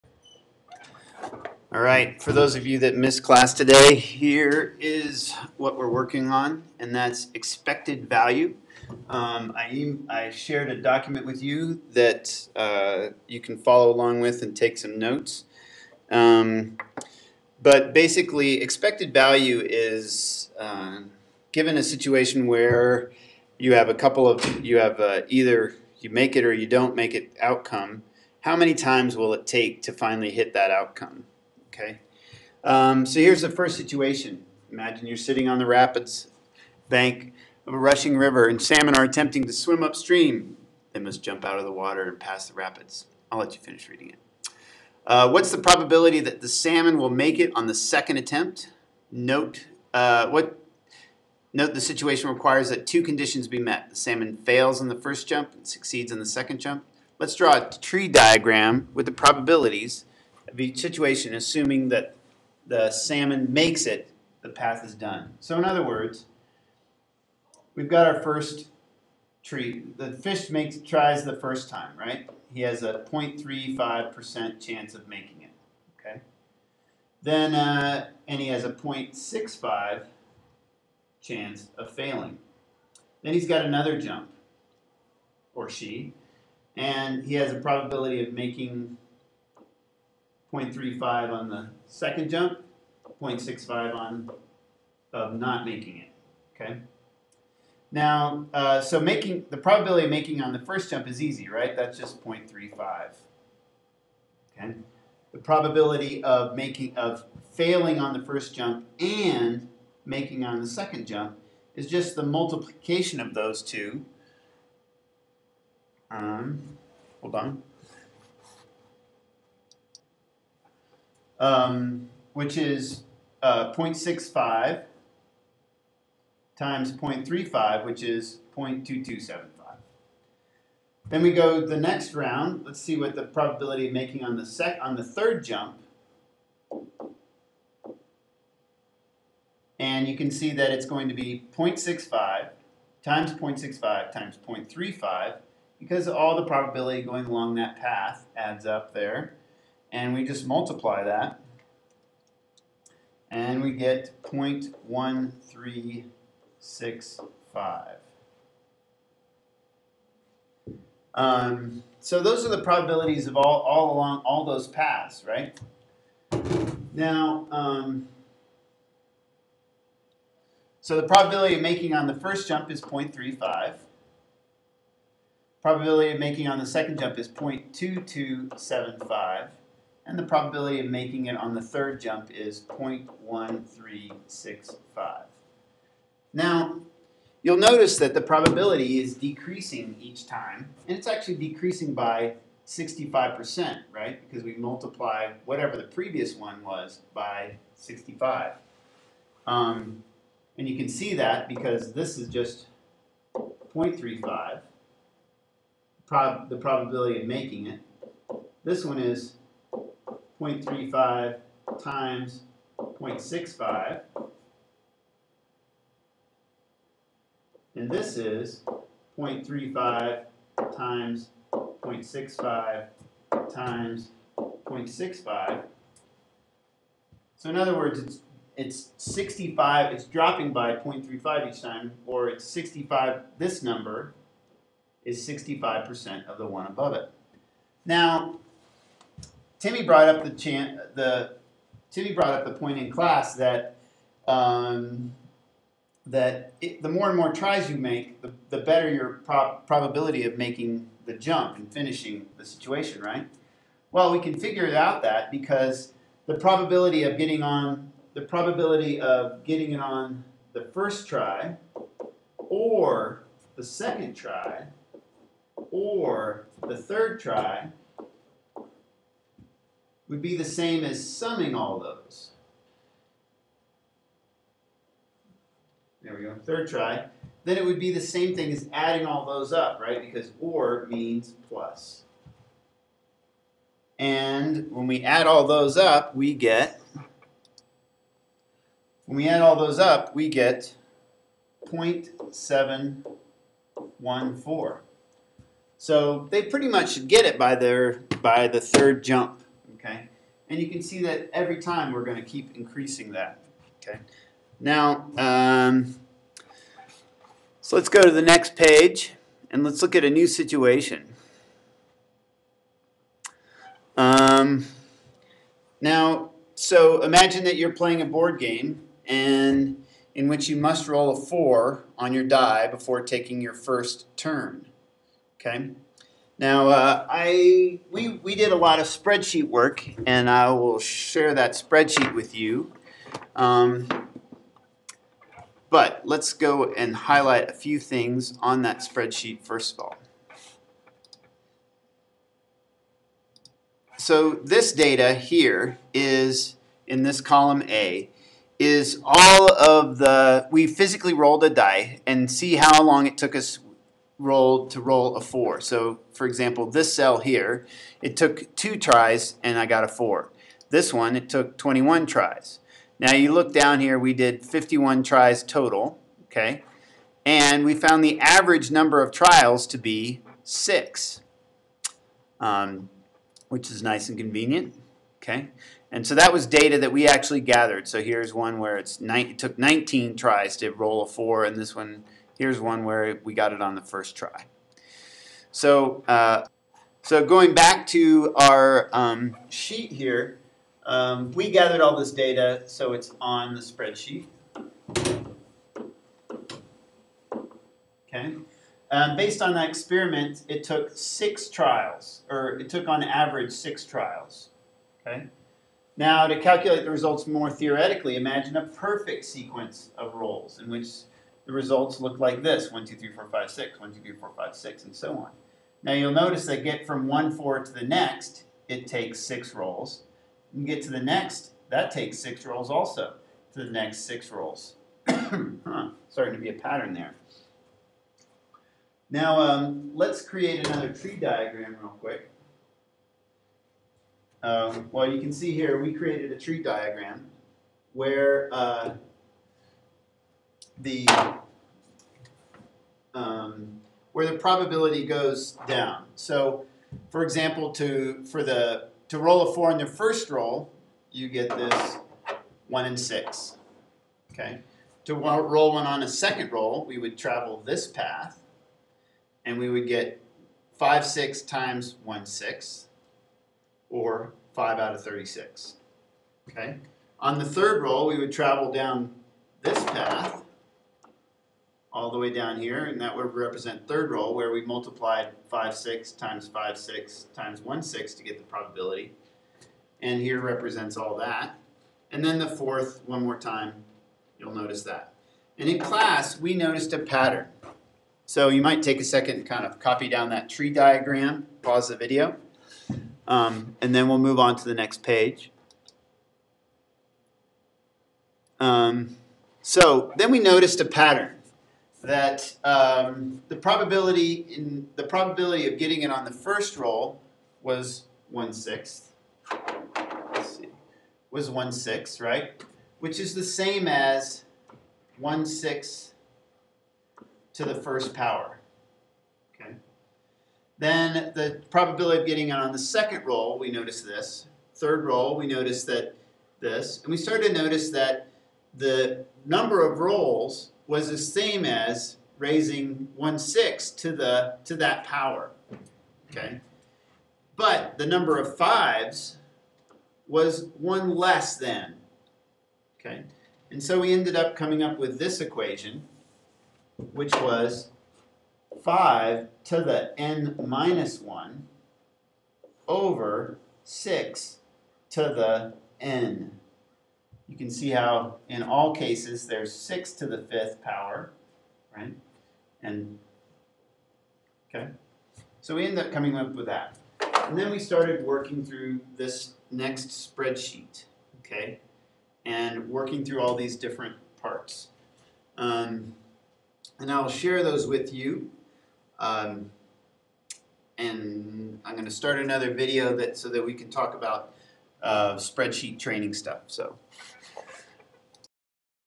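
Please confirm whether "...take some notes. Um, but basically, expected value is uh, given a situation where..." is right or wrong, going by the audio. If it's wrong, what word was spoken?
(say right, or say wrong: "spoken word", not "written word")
right.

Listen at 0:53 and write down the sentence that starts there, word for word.
The salmon fails on the first jump and succeeds on the second jump.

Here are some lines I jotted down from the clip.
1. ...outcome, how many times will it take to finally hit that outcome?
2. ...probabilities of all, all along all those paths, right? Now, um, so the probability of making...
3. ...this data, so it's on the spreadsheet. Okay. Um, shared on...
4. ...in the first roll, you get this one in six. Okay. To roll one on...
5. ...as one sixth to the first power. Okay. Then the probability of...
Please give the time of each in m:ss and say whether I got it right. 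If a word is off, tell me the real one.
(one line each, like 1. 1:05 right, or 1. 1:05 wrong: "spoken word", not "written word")
1. 0:27 right
2. 2:42 right
3. 6:31 wrong: "based", not "shared"
4. 7:29 right
5. 8:33 right.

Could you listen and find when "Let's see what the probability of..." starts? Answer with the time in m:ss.
2:12.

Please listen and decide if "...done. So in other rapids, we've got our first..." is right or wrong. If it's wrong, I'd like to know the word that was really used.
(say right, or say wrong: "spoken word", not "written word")
wrong: "words", not "rapids".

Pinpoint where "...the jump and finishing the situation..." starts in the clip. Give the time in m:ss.
4:11.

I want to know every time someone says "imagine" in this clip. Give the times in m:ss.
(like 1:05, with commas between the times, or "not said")
0:34, 5:17, 6:48.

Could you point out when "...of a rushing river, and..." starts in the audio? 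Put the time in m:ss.
0:37.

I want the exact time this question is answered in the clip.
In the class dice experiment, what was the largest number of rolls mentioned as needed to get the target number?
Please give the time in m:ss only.
6:01.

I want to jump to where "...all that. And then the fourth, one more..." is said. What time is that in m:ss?
8:00.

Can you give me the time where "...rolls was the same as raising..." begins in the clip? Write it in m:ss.
8:49.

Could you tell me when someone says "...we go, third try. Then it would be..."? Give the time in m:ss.
4:36.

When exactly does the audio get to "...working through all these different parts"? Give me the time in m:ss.
9:32.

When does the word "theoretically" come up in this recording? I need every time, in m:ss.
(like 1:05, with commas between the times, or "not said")
6:47.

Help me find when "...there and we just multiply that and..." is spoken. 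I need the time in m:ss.
2:28.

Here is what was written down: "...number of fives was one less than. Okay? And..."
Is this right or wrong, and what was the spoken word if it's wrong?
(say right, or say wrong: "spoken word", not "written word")
right.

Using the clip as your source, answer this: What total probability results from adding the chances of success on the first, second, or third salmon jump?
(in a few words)
0.714.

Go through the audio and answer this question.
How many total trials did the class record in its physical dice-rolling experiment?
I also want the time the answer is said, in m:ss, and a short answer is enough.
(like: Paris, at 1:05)
51, at 6:04.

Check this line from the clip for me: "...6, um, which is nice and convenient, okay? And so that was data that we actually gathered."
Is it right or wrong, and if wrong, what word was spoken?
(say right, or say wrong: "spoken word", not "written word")
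right.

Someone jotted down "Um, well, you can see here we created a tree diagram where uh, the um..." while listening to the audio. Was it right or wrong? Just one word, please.
right.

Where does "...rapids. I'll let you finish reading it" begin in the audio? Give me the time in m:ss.
0:42.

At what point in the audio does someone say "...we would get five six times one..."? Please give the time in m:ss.
7:39.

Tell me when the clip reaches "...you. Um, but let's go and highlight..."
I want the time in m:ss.
5:32.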